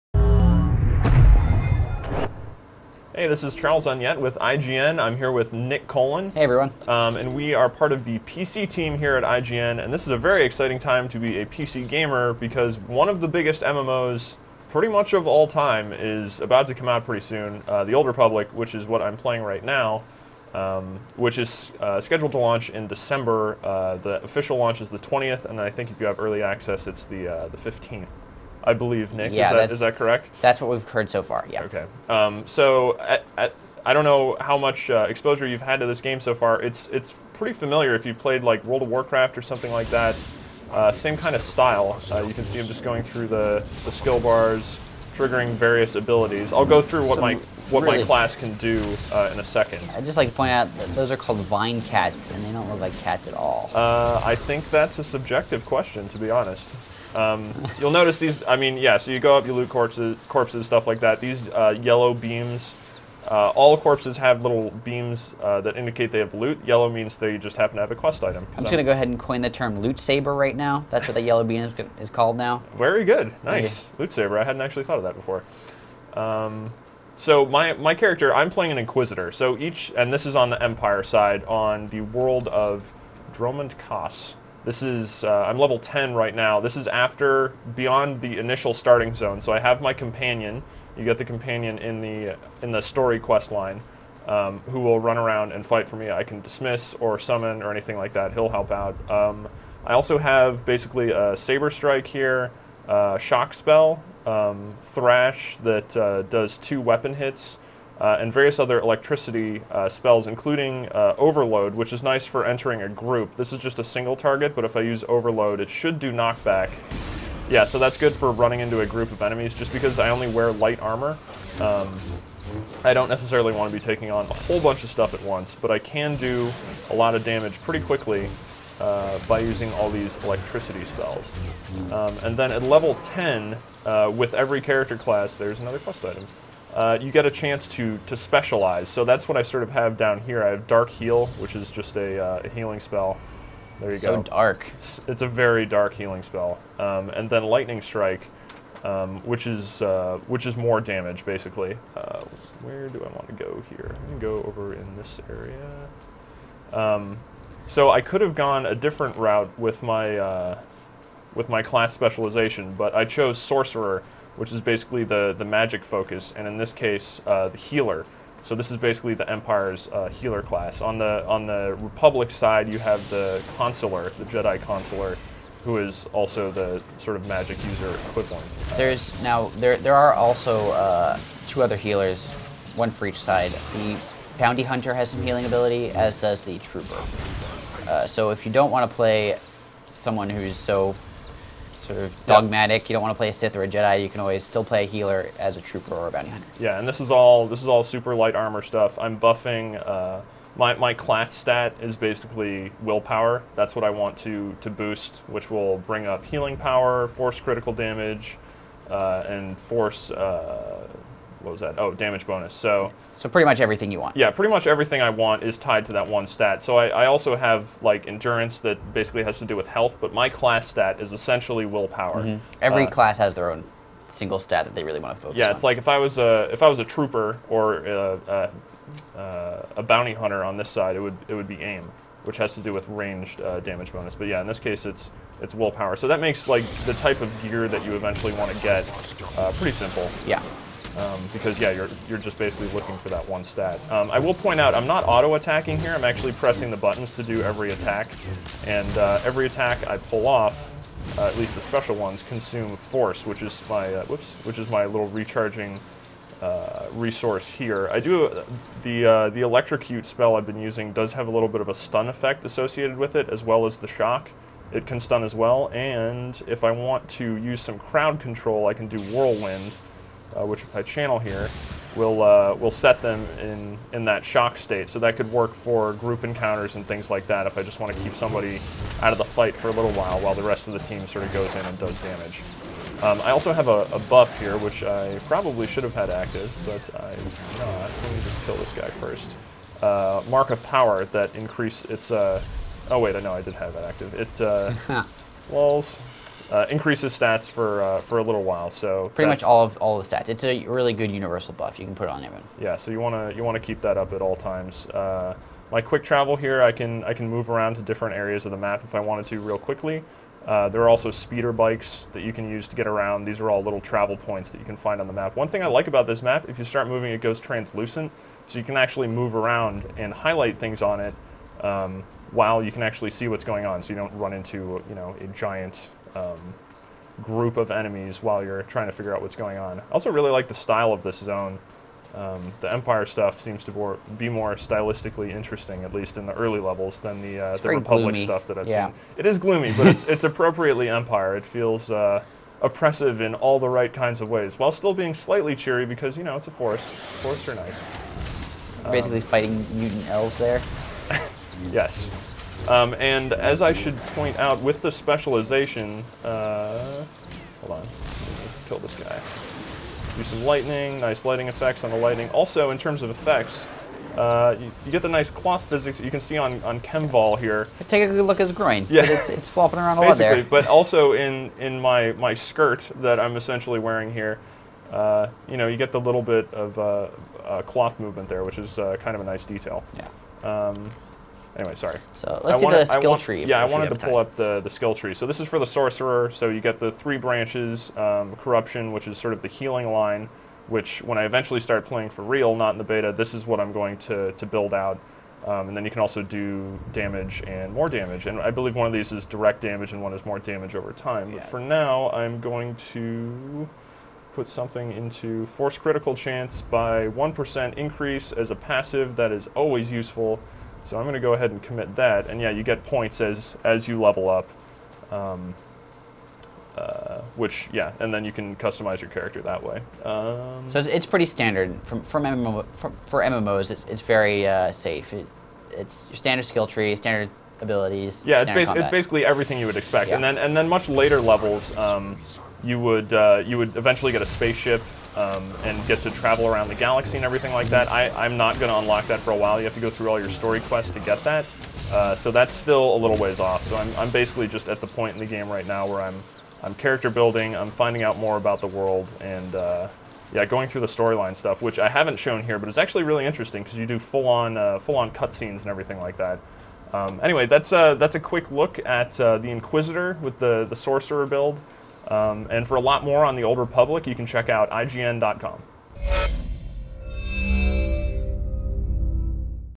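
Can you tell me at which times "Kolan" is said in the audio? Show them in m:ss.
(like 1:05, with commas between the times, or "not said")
0:05.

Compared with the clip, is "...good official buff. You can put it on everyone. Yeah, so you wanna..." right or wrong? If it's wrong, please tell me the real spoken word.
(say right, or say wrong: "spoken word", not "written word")
wrong: "universal", not "official".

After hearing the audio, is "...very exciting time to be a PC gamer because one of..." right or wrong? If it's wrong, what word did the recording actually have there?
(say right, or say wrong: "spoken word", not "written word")
right.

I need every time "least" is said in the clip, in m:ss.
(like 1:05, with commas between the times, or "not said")
4:11, 5:35.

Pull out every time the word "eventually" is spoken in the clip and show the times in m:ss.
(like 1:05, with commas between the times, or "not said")
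3:57, 6:31, 7:13.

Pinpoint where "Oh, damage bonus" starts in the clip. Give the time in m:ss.
3:31.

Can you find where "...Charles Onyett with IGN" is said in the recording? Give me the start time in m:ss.
0:03.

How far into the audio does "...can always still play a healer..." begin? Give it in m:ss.
3:14.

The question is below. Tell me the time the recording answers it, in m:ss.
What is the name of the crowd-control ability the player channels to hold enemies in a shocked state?
4:29.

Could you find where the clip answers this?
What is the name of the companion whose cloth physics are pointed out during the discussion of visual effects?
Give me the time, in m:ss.
6:06.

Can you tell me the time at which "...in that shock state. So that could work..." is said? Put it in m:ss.
4:33.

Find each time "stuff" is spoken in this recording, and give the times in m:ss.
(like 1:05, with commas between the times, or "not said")
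1:00, 2:04, 3:18, 5:33, 5:38, 7:31.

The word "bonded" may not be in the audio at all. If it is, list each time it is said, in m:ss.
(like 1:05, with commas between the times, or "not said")
not said.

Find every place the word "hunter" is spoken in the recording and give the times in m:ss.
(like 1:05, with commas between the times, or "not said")
3:04, 3:16, 3:50.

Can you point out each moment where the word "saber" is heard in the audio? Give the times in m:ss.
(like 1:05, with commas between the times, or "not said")
1:09, 1:14, 1:41.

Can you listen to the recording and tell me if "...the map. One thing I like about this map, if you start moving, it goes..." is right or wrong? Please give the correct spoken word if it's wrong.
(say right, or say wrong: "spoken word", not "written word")
right.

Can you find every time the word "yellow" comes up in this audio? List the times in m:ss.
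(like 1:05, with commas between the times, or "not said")
1:01, 1:06, 1:11.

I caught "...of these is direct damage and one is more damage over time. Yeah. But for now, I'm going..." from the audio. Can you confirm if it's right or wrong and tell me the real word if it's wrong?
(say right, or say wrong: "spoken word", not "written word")
right.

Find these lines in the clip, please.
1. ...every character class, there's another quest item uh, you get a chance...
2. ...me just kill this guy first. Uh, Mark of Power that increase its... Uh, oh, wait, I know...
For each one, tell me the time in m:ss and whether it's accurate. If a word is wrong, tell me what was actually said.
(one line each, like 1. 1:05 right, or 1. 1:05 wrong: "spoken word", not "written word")
1. 2:14 right
2. 4:47 right.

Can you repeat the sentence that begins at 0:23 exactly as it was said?
Uh, the official launch is the 20th, and I think if you have early access, it's the, uh, the 15th.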